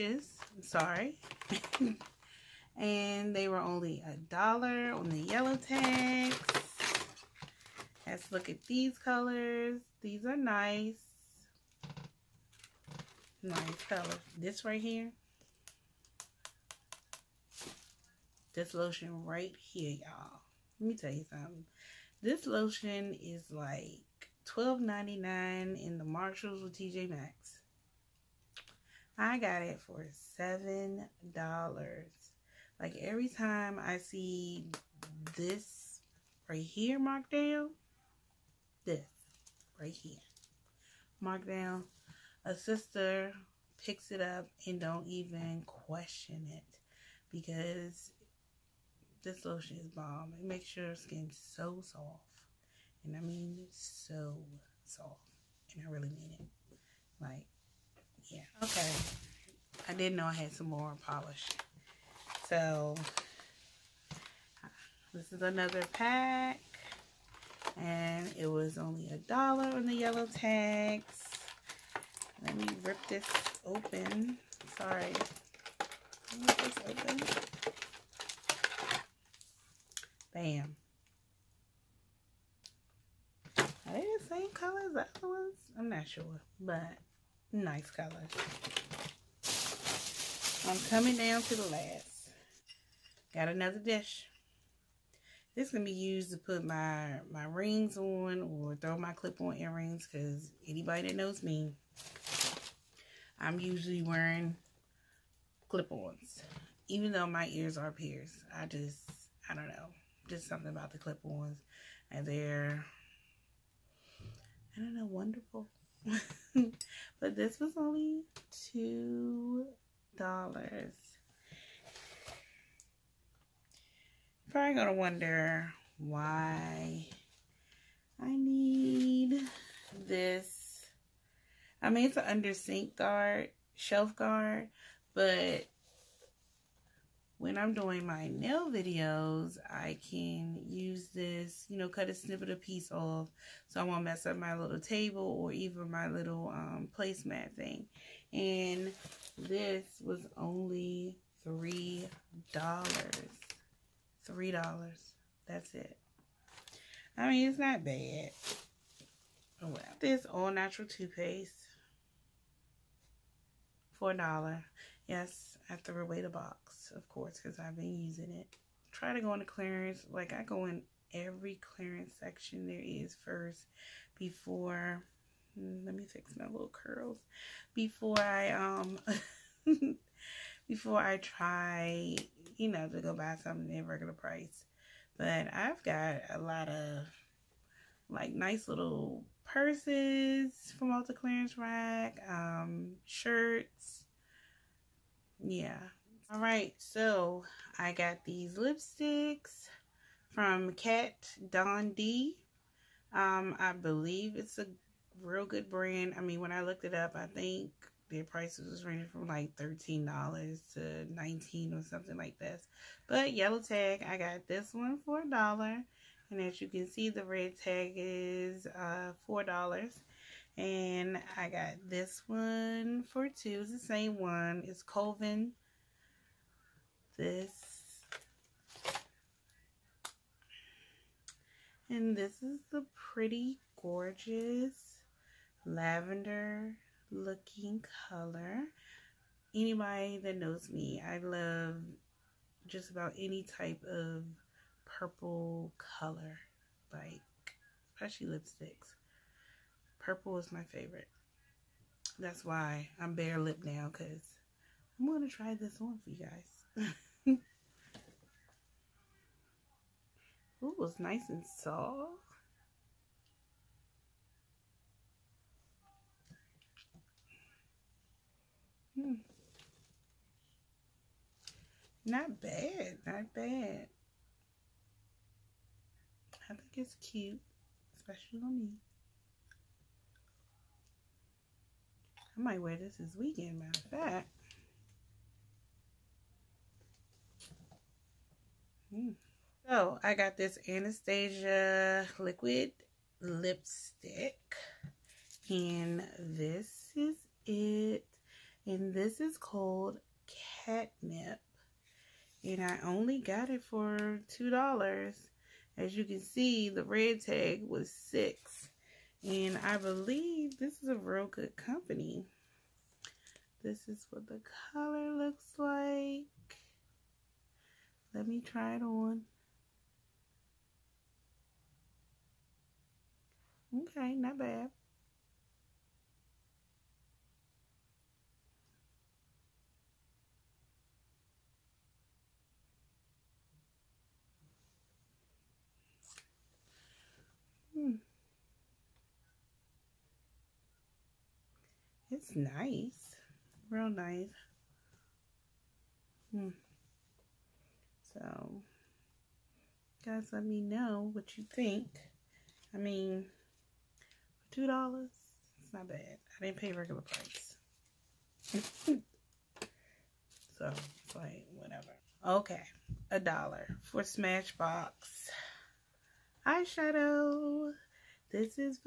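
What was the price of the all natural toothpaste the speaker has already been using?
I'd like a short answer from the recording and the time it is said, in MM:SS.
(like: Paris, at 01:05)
$4, at 02:43.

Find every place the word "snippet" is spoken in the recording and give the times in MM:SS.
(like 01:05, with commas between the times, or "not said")
02:22.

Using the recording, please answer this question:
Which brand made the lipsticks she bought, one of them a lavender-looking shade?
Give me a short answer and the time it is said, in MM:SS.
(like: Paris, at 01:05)
Kat Von D, at 03:20.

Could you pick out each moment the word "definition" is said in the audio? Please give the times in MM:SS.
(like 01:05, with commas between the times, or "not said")
not said.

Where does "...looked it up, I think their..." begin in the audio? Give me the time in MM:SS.
03:26.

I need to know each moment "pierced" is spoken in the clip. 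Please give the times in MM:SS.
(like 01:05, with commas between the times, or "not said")
01:47.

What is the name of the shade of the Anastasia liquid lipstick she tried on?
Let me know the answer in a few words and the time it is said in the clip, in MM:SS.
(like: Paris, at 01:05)
Catnip, at 05:00.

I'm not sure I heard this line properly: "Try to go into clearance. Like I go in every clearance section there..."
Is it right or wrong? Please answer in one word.
right.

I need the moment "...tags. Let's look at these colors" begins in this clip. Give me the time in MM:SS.
00:05.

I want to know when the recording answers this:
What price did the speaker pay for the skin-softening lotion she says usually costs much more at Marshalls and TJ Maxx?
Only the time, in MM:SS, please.
00:30.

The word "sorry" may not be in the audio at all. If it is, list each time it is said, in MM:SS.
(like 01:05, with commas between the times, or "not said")
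00:00, 01:14.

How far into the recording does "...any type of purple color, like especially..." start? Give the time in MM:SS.
04:03.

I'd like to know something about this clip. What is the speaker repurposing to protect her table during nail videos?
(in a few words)
under sink guard.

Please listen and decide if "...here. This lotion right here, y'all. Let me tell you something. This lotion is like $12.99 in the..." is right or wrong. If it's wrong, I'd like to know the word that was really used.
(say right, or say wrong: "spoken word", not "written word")
right.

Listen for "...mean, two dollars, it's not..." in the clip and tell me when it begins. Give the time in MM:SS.
05:52.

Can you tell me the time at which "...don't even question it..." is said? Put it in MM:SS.
00:44.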